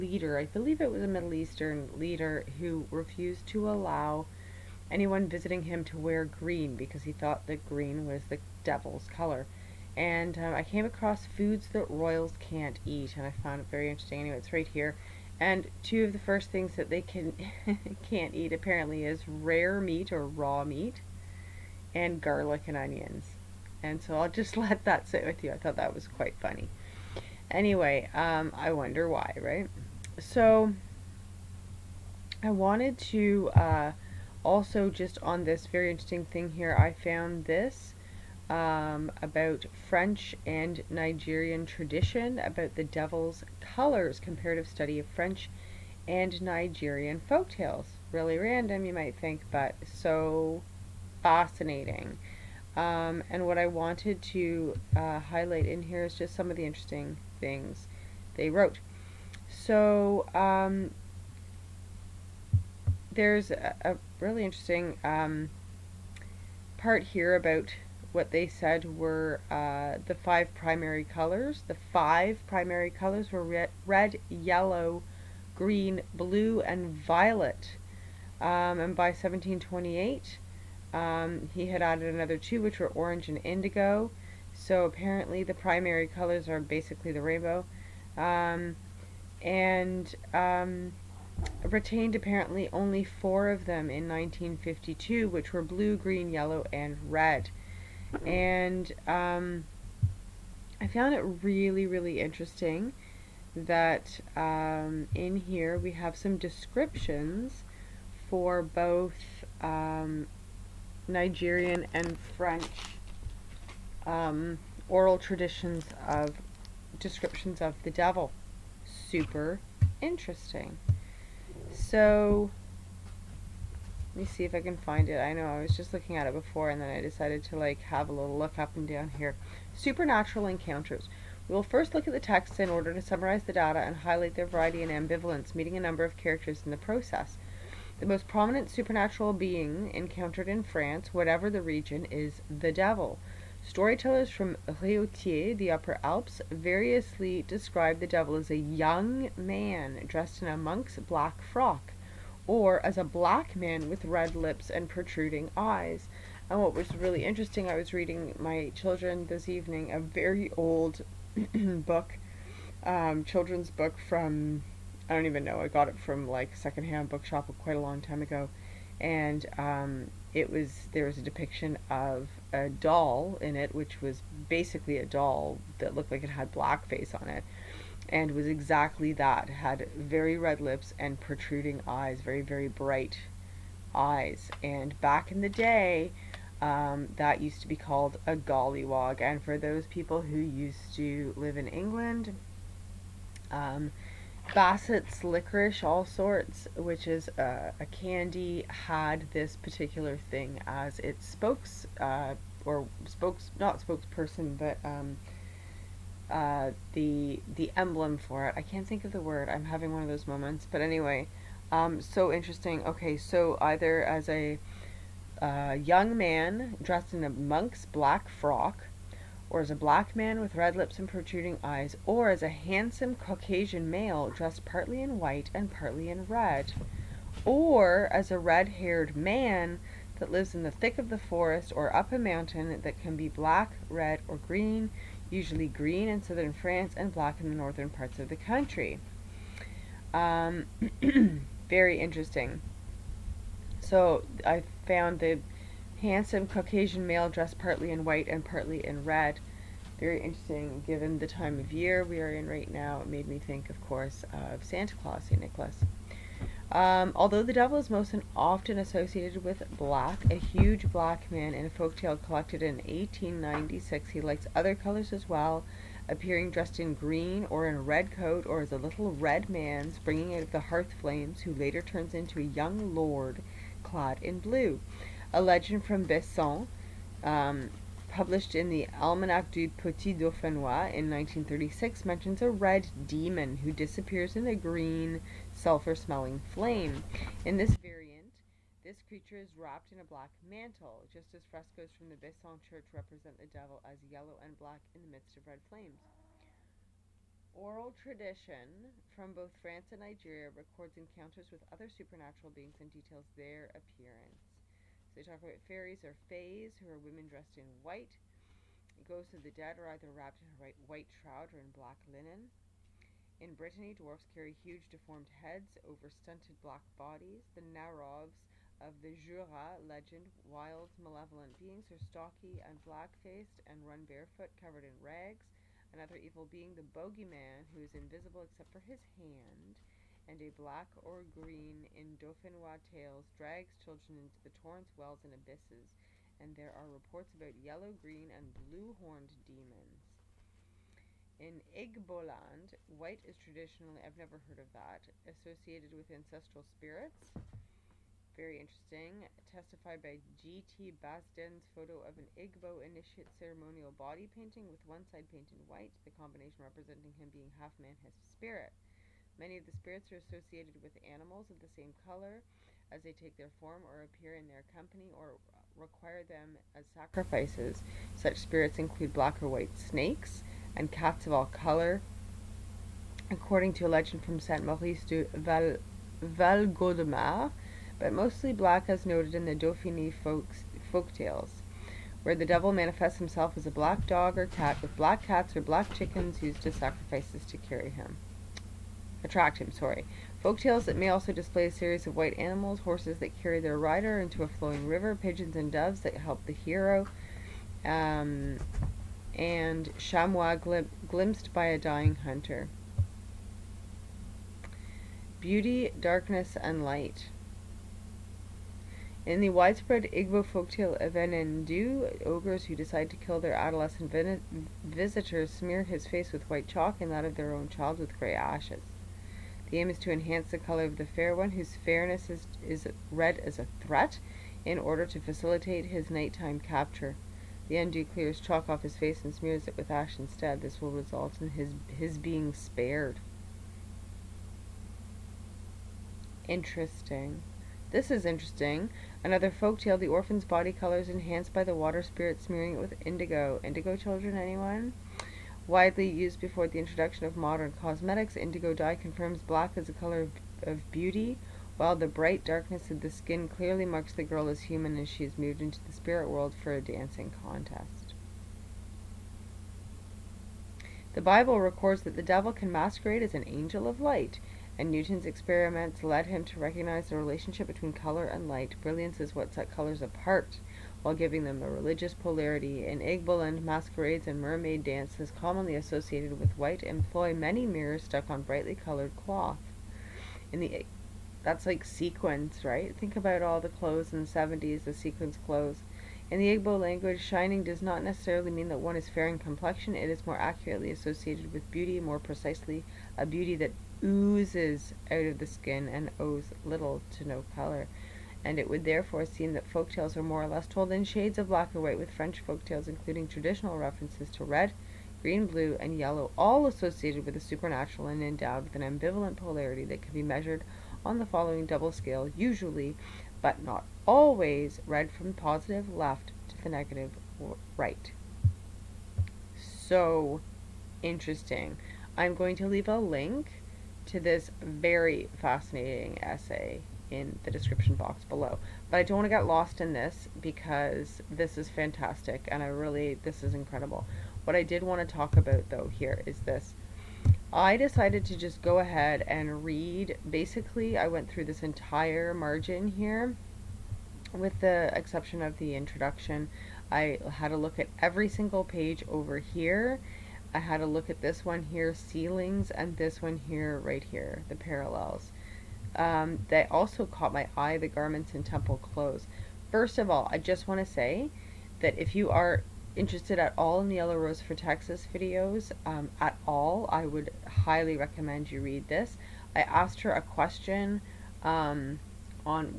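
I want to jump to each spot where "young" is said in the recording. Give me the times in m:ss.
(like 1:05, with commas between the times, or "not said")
2:28, 3:35, 4:32.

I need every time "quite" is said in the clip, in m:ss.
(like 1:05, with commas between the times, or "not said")
0:26, 2:47.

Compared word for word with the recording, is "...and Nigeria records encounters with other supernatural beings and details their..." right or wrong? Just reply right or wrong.
right.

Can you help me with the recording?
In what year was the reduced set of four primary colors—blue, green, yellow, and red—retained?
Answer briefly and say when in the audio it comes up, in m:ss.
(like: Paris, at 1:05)
1952, at 1:34.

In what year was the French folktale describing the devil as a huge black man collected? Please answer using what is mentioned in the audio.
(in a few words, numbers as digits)
1896.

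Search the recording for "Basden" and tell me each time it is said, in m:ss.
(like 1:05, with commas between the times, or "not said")
5:50.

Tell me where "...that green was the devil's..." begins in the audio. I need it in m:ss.
0:07.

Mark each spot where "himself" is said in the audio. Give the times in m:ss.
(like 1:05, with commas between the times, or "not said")
6:23.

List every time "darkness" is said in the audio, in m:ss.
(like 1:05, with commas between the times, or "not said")
6:45, 7:32.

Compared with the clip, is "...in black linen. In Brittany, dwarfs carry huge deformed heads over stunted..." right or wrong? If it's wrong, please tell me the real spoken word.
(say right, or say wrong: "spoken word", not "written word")
right.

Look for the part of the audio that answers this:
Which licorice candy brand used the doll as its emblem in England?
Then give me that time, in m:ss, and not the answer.
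3:14.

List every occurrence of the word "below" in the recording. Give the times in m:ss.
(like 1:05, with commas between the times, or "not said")
8:48.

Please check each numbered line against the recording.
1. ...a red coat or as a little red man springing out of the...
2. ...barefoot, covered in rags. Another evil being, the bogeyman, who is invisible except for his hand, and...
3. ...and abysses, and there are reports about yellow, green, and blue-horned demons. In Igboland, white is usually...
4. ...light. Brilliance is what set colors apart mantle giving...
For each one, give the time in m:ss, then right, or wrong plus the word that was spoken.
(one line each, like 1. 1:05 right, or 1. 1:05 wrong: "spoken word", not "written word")
1. 4:27 right
2. 5:24 right
3. 5:35 wrong: "traditionally", not "usually"
4. 7:48 wrong: "while", not "mantle".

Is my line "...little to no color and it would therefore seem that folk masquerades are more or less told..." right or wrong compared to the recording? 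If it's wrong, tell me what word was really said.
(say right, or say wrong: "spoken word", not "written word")
wrong: "tales", not "masquerades".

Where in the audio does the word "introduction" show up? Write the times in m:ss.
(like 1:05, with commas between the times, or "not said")
7:26, 9:05.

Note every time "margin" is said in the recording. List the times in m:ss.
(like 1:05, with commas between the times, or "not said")
9:02.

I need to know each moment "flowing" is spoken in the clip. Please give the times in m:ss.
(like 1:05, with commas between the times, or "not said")
6:34.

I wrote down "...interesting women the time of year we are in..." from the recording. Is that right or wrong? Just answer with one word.
wrong.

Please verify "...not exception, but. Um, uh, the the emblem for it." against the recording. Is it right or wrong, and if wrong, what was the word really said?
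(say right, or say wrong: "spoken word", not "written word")
wrong: "spokesperson", not "exception".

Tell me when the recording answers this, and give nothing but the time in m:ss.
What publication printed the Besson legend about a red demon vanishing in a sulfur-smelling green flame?
4:38.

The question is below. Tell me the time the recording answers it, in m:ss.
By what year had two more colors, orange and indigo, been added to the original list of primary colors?
1:19.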